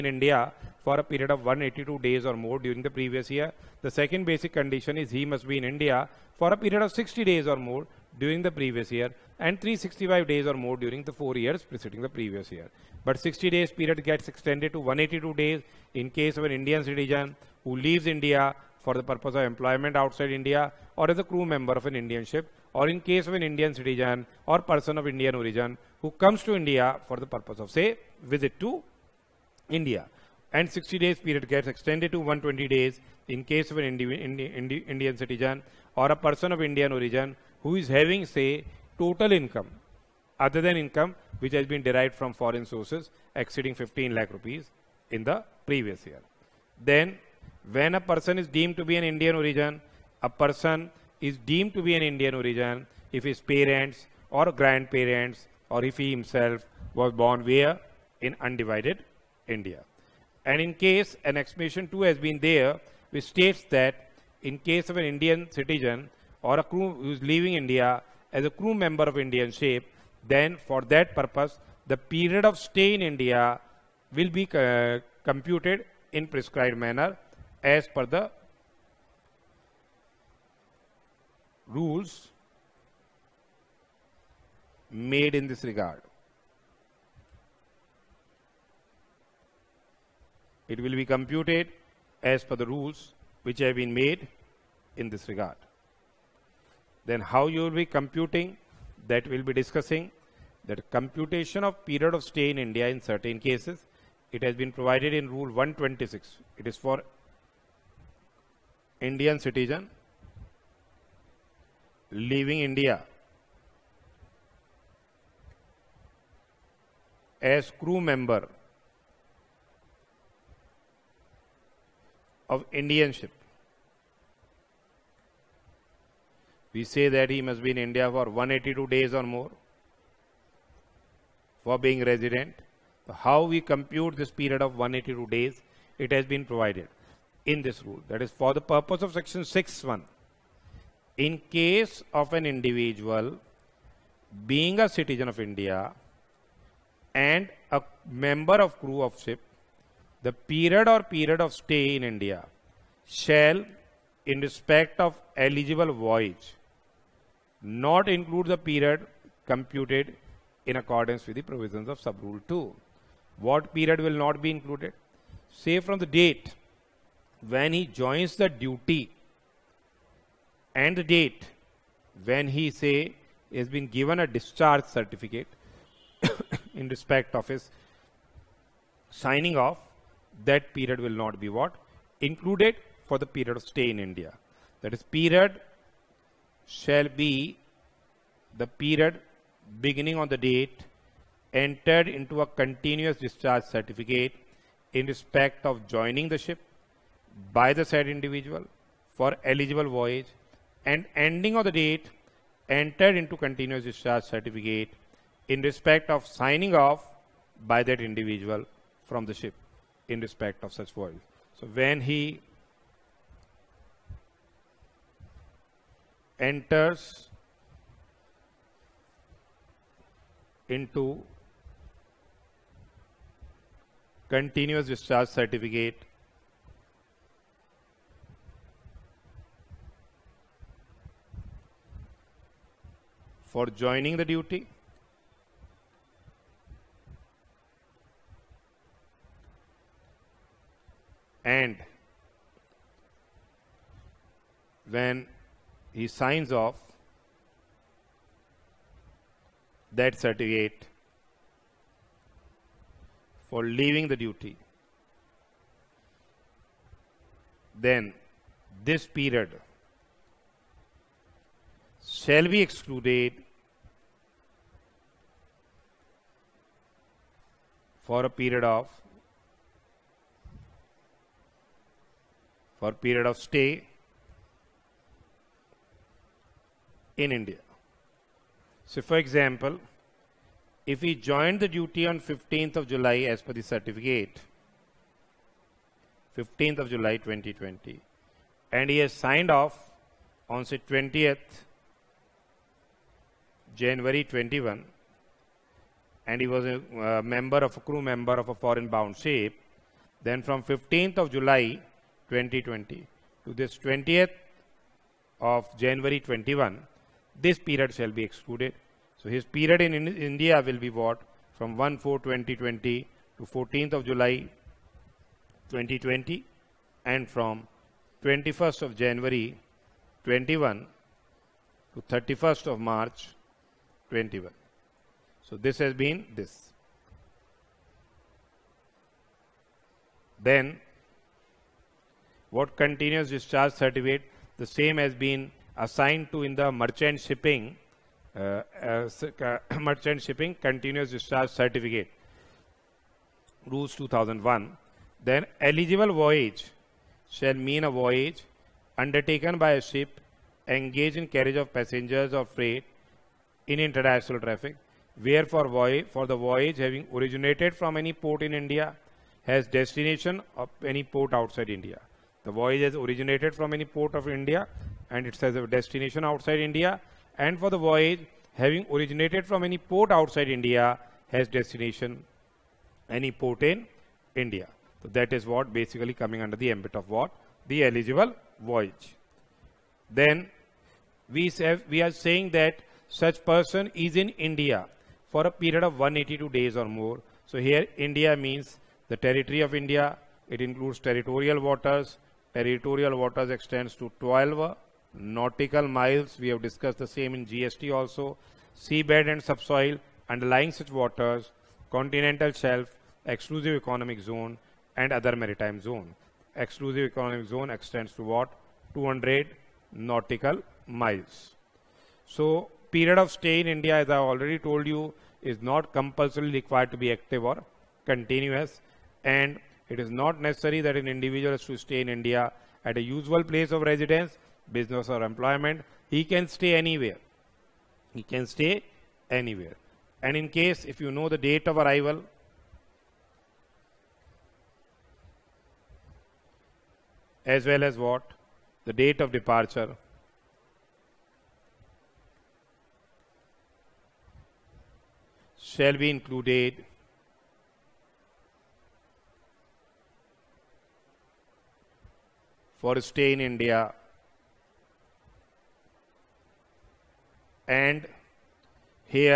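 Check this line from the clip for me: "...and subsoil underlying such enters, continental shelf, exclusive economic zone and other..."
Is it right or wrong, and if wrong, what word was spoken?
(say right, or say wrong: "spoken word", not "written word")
wrong: "waters", not "enters".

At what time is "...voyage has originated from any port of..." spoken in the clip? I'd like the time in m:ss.
6:02.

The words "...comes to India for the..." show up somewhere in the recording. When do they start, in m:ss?
0:26.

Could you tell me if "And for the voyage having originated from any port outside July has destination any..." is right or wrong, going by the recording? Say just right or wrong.
wrong.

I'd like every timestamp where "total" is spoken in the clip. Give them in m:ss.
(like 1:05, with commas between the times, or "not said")
0:38.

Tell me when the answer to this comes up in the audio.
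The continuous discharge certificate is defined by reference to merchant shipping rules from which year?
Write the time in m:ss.
5:43.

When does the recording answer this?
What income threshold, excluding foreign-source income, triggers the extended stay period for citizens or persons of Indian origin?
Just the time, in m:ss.
0:43.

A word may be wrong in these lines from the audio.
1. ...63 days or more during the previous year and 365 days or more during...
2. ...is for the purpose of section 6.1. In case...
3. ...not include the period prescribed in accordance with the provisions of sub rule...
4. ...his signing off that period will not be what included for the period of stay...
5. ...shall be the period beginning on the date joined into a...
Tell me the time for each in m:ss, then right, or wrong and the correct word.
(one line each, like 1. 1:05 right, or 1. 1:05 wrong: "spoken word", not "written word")
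1. 0:06 wrong: "60", not "63"
2. 2:18 right
3. 2:37 wrong: "computed", not "prescribed"
4. 2:57 right
5. 3:06 wrong: "entered", not "joined".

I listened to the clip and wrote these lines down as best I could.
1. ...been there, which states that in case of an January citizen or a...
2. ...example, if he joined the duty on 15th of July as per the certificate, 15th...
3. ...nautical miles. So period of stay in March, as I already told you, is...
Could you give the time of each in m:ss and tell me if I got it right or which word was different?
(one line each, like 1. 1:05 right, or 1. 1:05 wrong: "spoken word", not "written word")
1. 1:02 wrong: "Indian", not "January"
2. 4:39 right
3. 6:49 wrong: "India", not "March".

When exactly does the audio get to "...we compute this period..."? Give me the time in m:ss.
2:13.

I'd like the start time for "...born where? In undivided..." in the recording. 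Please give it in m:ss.
0:57.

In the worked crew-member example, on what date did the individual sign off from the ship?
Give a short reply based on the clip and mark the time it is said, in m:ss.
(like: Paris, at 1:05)
20 January 2021, at 4:50.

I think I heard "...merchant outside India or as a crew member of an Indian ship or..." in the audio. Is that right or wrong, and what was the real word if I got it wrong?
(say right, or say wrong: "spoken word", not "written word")
wrong: "employment", not "merchant".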